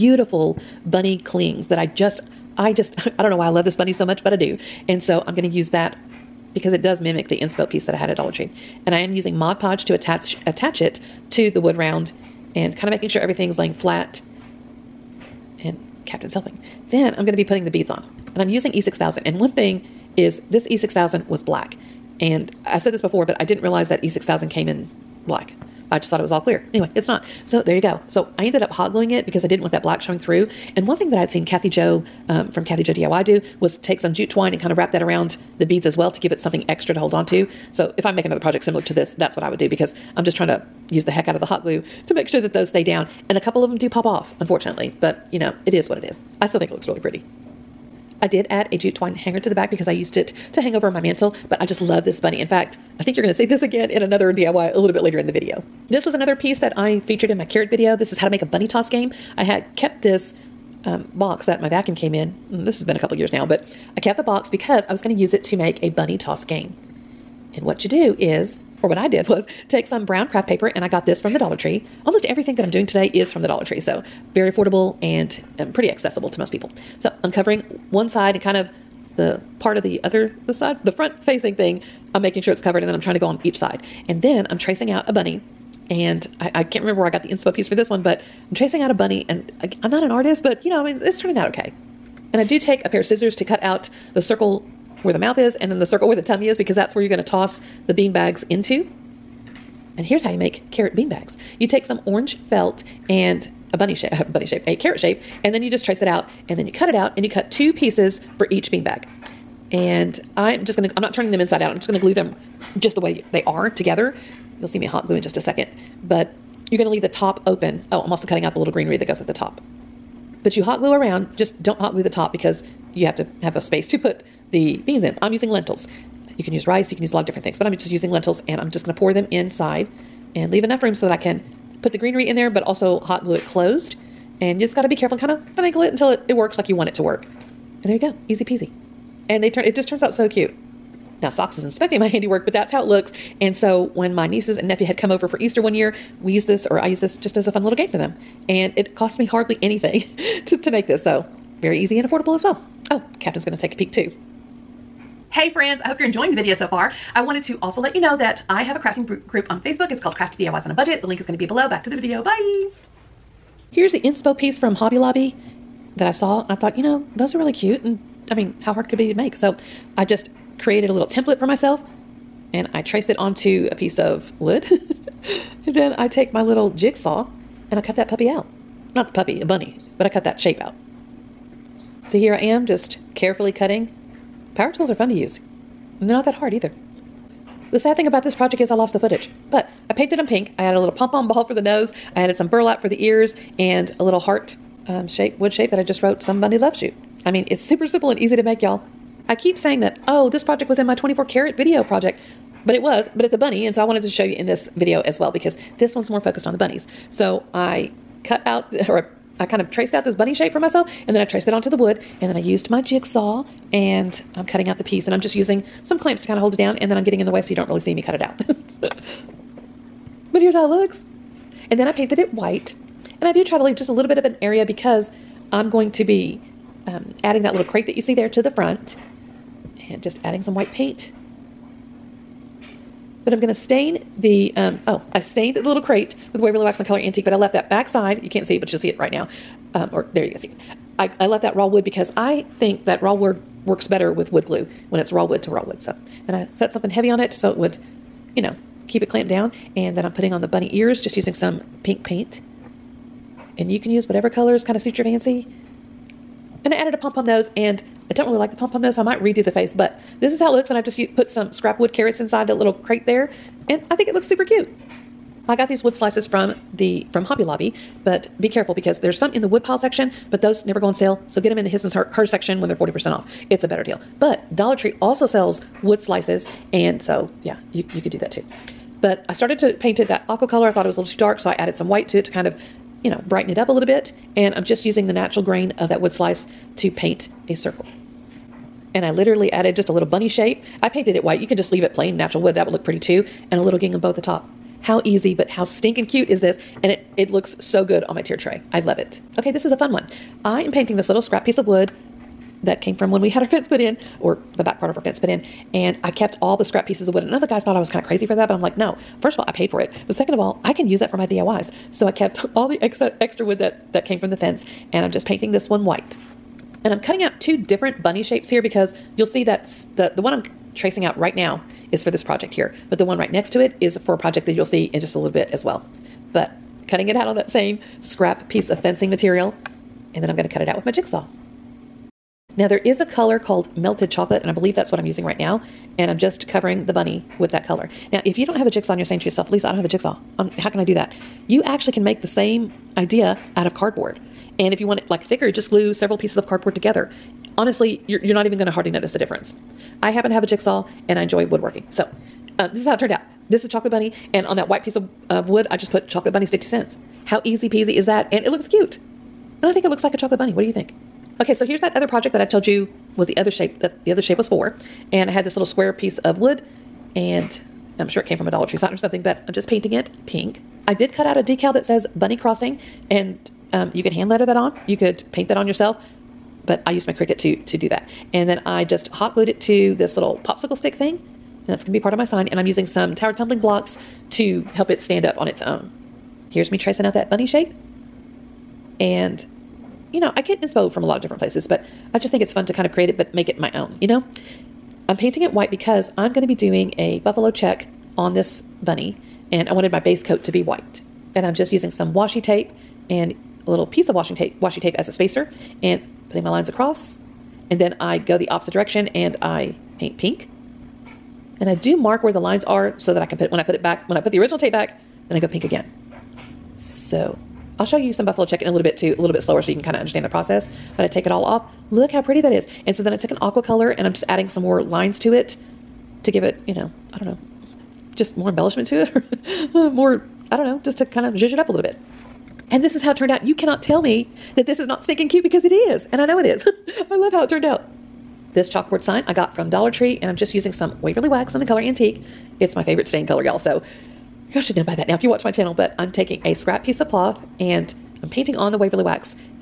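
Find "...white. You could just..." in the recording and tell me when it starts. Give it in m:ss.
4:51.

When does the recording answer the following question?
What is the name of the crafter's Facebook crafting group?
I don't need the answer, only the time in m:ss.
2:40.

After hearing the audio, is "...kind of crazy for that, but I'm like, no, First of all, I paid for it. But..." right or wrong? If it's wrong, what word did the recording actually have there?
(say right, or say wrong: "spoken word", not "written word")
right.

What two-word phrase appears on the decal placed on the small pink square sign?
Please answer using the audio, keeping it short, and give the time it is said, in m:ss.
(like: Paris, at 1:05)
Bunny crossing, at 6:12.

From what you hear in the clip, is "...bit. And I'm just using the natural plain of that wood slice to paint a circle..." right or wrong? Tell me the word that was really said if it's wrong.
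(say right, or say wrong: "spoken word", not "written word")
wrong: "grain", not "plain".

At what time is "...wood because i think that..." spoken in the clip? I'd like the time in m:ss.
4:01.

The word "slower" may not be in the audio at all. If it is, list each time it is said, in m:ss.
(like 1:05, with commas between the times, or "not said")
6:59.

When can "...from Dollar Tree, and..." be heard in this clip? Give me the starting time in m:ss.
7:19.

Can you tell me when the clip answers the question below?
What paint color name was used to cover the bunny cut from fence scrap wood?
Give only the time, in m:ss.
5:33.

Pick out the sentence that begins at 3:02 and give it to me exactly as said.
See here I am just carefully cutting.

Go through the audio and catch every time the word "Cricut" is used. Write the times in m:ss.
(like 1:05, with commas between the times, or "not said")
6:17.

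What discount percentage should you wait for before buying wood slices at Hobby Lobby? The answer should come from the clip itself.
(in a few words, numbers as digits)
40%.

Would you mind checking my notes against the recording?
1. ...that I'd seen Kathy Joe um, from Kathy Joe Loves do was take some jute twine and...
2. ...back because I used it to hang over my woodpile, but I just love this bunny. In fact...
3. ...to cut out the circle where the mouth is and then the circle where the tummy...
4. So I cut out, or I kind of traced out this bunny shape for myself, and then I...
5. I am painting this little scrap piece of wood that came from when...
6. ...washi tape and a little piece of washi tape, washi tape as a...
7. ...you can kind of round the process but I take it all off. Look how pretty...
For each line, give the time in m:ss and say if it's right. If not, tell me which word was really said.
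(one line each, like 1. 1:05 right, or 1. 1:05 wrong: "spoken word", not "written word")
1. 0:31 wrong: "DIY", not "Loves"
2. 0:49 wrong: "mantle", not "woodpile"
3. 1:33 right
4. 3:27 right
5. 5:00 right
6. 6:42 right
7. 6:59 wrong: "understand", not "round".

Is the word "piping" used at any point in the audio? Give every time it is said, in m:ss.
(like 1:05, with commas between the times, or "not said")
not said.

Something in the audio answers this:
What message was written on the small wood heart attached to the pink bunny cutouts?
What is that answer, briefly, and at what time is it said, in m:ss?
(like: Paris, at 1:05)
Somebody Loves You, at 3:16.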